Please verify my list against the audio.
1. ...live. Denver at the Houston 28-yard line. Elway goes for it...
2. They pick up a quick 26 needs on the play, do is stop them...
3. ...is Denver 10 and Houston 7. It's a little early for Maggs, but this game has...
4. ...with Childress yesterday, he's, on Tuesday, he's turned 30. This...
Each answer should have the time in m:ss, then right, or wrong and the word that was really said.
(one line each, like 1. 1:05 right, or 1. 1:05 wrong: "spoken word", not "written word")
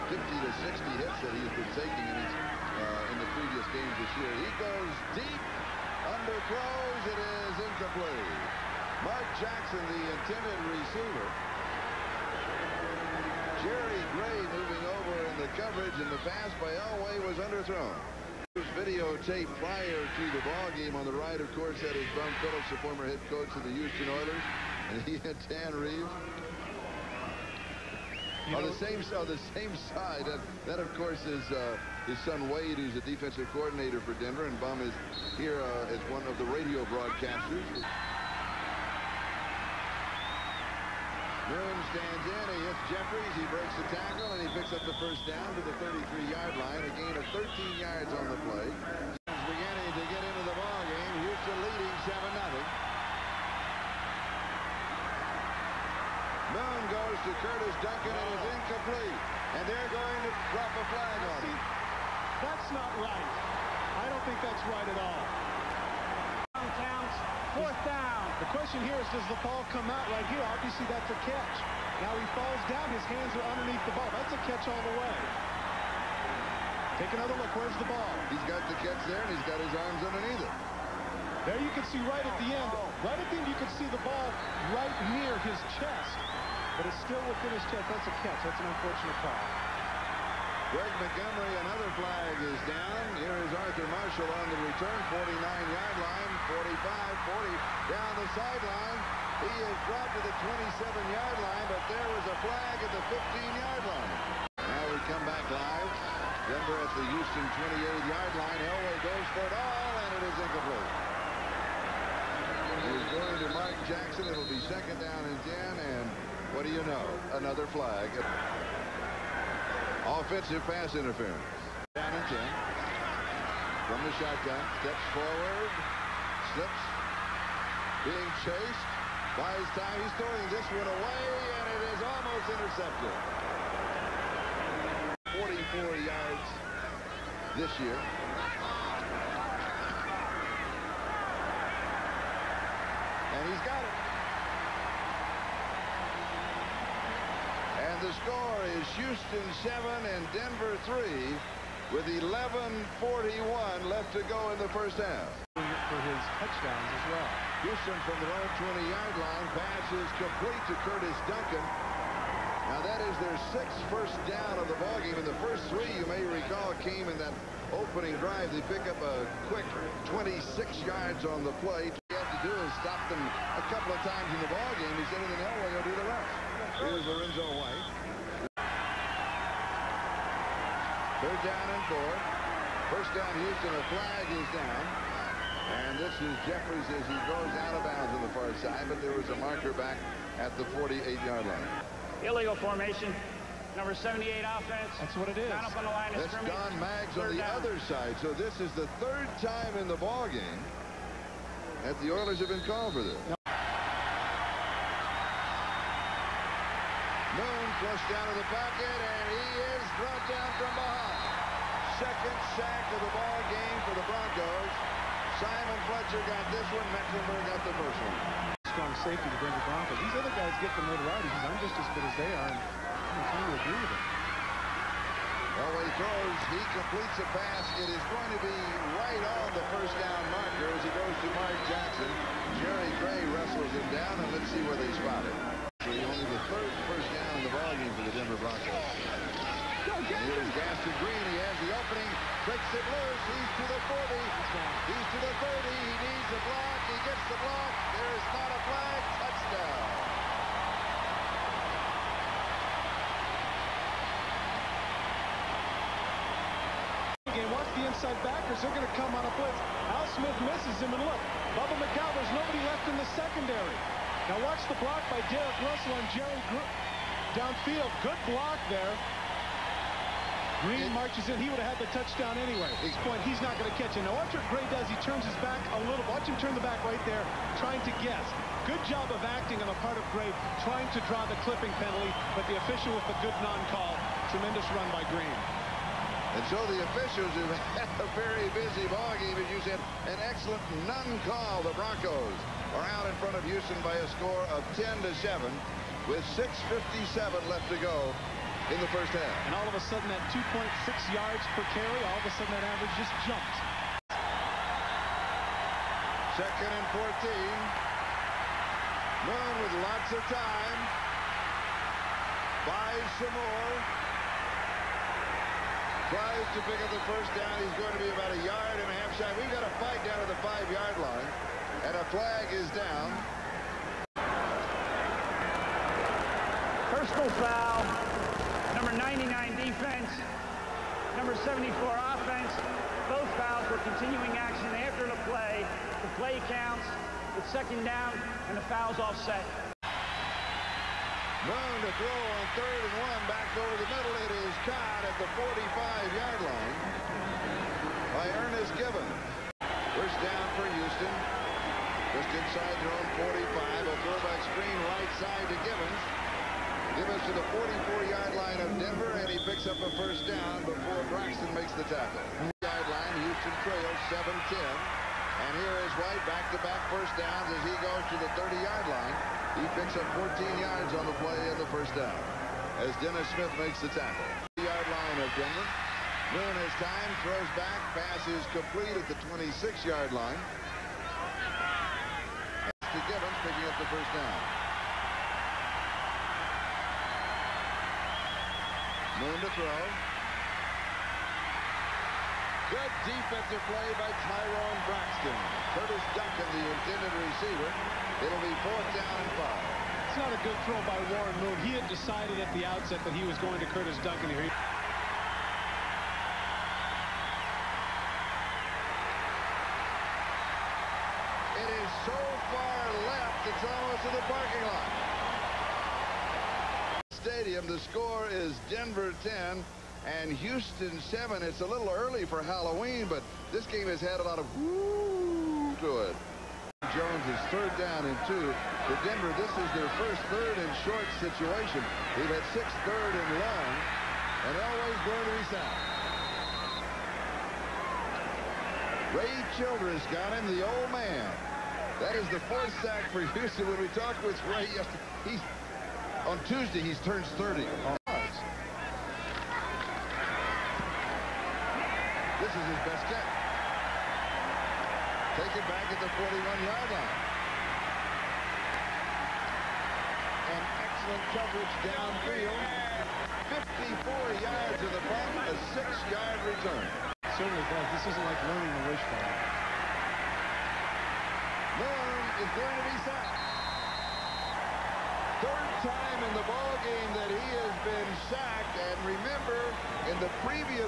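1. 1:45 right
2. 2:48 wrong: "yards", not "needs"
3. 6:58 wrong: "Halloween", not "Maggs"
4. 7:24 wrong: "Ray", not "Childress".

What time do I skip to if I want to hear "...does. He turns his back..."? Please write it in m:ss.
4:34.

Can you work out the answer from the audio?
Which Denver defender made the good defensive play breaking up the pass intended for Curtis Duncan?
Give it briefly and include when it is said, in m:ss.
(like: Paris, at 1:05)
Tyrone Braxton, at 6:34.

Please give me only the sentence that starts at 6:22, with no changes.
To Givins picking up the first down.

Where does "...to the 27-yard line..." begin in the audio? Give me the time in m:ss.
1:40.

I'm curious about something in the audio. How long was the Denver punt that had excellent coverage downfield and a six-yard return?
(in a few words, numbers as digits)
54 yards.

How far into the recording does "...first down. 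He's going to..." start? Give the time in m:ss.
5:17.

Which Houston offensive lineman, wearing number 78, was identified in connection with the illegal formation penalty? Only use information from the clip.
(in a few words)
Don Maggs.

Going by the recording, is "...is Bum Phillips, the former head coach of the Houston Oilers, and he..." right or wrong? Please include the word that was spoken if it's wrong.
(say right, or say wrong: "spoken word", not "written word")
right.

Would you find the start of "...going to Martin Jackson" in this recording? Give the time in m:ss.
1:53.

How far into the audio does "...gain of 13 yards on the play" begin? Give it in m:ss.
0:46.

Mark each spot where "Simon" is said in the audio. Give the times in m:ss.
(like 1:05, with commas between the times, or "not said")
3:35.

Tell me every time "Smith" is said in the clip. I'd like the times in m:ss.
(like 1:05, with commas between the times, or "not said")
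4:20, 6:13.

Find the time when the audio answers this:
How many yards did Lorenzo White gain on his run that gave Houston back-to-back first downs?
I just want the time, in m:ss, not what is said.
6:10.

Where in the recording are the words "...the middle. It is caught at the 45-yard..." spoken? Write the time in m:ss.
5:43.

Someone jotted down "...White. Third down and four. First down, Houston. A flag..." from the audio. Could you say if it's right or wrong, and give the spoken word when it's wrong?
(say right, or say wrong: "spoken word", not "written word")
right.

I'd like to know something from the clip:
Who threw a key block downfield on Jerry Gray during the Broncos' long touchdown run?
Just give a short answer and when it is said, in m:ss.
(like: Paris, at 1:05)
Derek Russell, at 4:25.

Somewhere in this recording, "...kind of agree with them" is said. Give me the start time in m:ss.
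3:43.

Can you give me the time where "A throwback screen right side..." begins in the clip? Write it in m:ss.
5:53.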